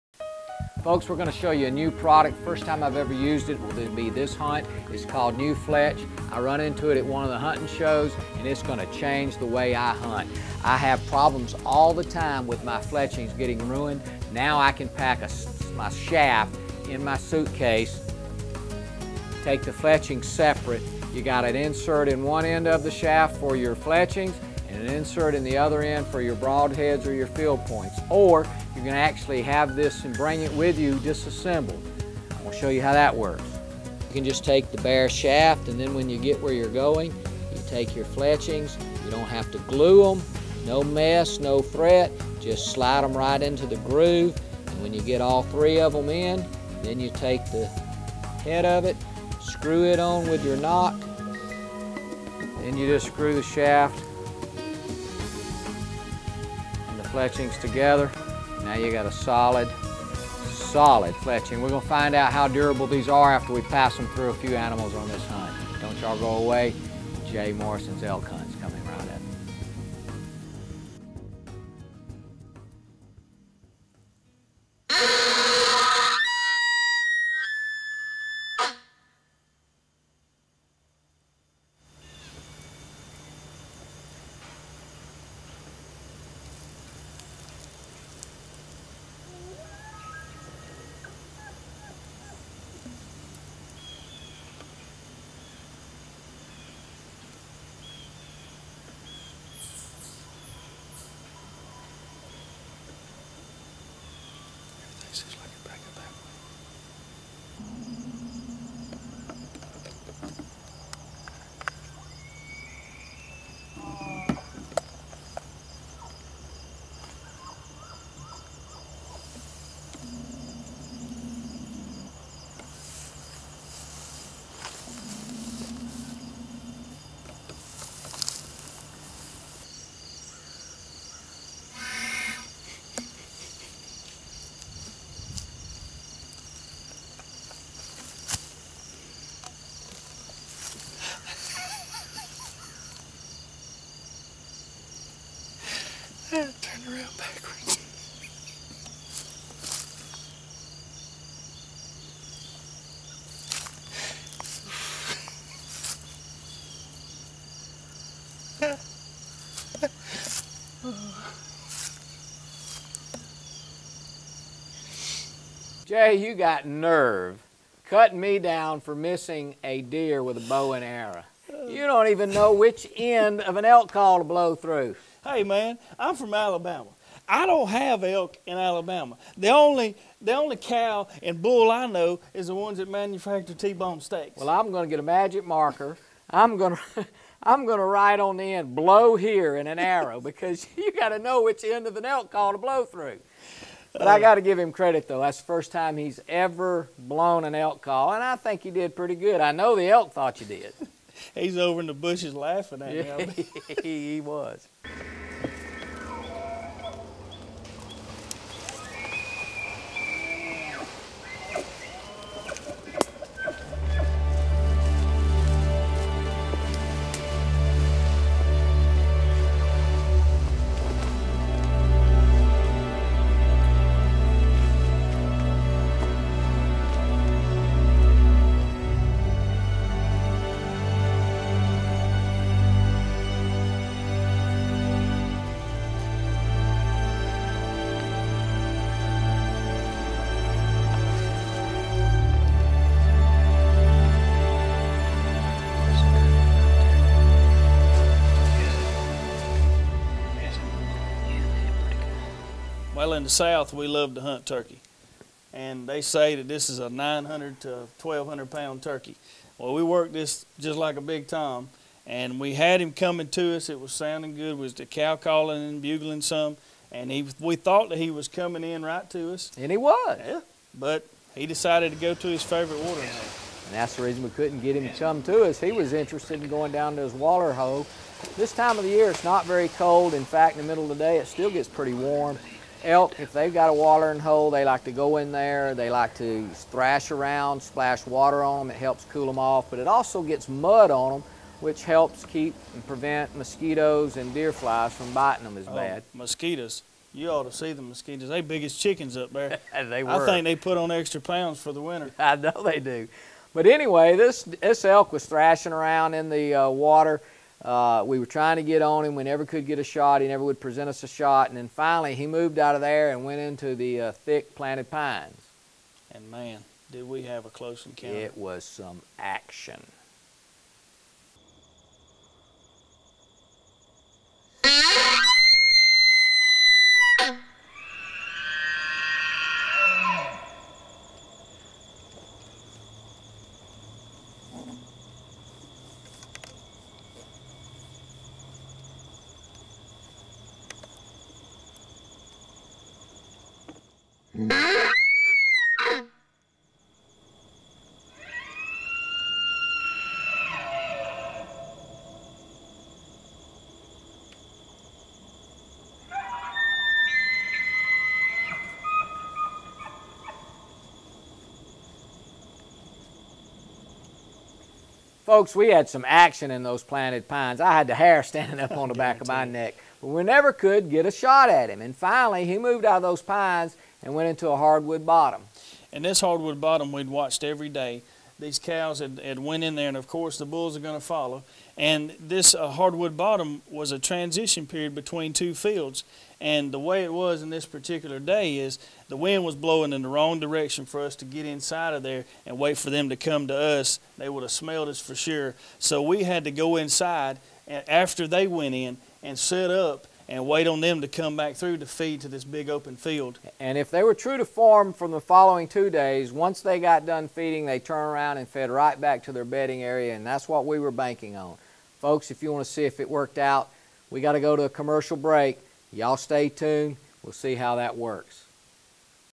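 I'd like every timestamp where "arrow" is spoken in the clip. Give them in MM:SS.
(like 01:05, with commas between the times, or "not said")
02:50, 03:09.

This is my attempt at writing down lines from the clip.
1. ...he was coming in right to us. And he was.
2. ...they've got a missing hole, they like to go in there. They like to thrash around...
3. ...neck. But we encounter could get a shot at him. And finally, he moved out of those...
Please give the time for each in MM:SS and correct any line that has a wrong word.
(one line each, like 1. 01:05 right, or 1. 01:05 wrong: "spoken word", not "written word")
1. 04:27 right
2. 04:43 wrong: "watering", not "missing"
3. 06:09 wrong: "never", not "encounter".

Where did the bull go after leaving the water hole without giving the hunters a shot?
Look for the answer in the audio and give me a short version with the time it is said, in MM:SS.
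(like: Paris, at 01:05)
thick planted pines, at 05:14.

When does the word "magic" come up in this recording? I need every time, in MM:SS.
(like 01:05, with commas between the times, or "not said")
03:05.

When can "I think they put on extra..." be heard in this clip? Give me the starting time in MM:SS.
05:00.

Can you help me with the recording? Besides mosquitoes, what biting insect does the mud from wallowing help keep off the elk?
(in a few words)
deer flies.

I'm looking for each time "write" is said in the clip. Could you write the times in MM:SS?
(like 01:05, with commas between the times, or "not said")
03:07.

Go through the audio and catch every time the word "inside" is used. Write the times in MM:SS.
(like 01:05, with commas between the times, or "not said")
06:31, 06:36.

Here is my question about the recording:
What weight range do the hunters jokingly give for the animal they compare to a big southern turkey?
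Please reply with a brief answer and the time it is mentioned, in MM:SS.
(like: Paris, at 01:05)
900 to 1,200 pounds, at 04:16.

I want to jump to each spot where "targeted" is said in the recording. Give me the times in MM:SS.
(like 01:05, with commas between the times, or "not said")
not said.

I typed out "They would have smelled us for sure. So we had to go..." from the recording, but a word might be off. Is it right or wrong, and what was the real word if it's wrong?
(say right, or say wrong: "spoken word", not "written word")
right.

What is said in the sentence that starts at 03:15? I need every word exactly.
That's the first time he's ever blown an elk call, and I think he did pretty good.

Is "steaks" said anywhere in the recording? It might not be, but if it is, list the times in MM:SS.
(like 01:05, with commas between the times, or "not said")
03:04.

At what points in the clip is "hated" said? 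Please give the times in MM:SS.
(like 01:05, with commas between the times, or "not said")
not said.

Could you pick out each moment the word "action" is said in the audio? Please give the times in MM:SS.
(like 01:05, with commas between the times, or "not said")
05:19, 06:06.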